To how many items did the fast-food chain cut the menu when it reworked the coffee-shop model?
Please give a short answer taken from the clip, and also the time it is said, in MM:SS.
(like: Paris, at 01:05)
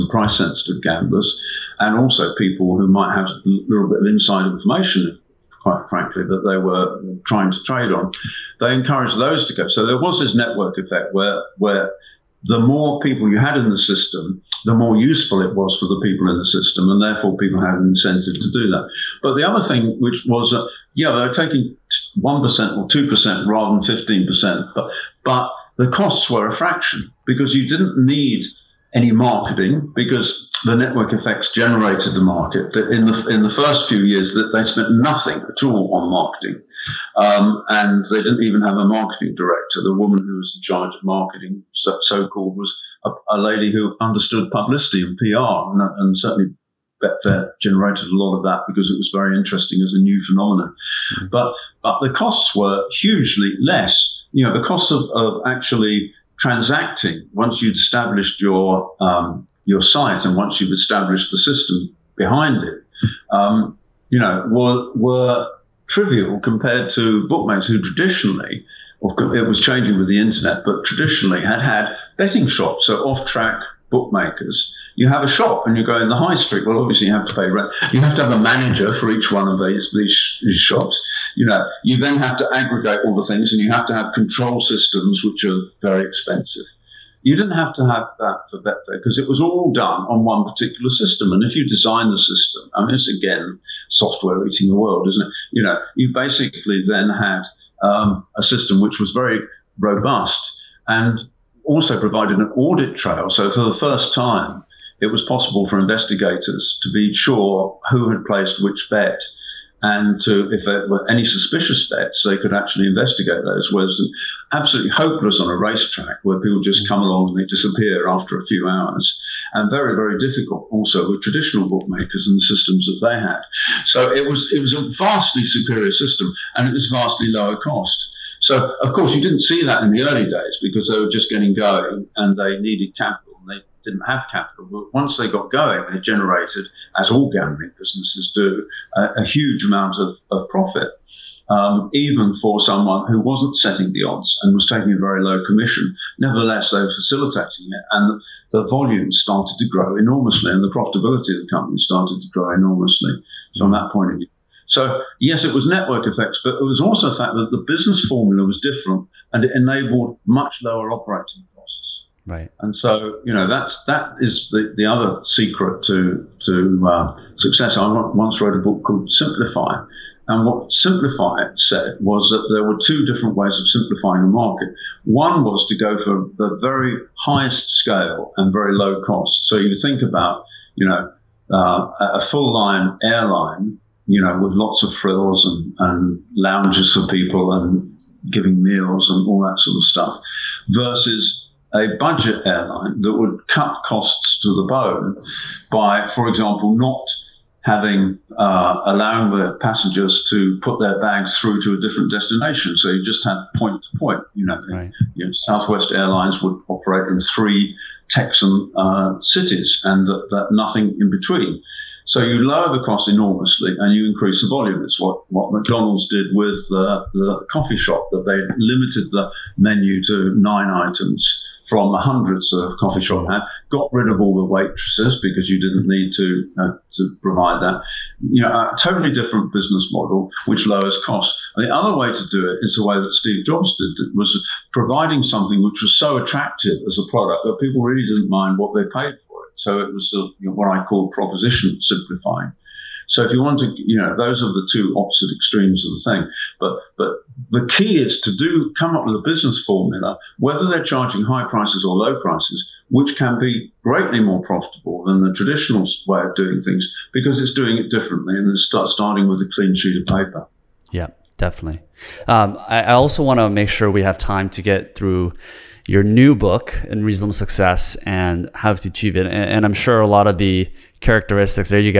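9, at 03:40.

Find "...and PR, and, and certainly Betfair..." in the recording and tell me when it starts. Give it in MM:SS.
00:45.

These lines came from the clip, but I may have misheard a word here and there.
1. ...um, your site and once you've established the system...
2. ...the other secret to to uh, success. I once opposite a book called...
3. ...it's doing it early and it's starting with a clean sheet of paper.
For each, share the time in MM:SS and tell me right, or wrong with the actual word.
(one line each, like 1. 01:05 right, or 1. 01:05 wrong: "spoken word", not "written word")
1. 00:58 right
2. 02:44 wrong: "wrote", not "opposite"
3. 04:17 wrong: "differently", not "early".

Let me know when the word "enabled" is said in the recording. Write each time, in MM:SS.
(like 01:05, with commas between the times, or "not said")
02:39.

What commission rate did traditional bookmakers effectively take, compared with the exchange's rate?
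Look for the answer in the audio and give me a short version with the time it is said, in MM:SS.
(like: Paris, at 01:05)
15%, at 00:24.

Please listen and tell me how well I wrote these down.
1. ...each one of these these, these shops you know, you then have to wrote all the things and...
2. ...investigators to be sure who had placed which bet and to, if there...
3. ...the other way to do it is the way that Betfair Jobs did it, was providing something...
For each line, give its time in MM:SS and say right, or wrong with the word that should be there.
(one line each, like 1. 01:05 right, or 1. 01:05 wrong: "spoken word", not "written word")
1. 01:19 wrong: "aggregate", not "wrote"
2. 01:45 right
3. 03:51 wrong: "Steve", not "Betfair".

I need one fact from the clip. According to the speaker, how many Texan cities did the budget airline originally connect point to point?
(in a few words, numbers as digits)
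3.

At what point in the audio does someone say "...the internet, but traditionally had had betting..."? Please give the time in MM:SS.
01:10.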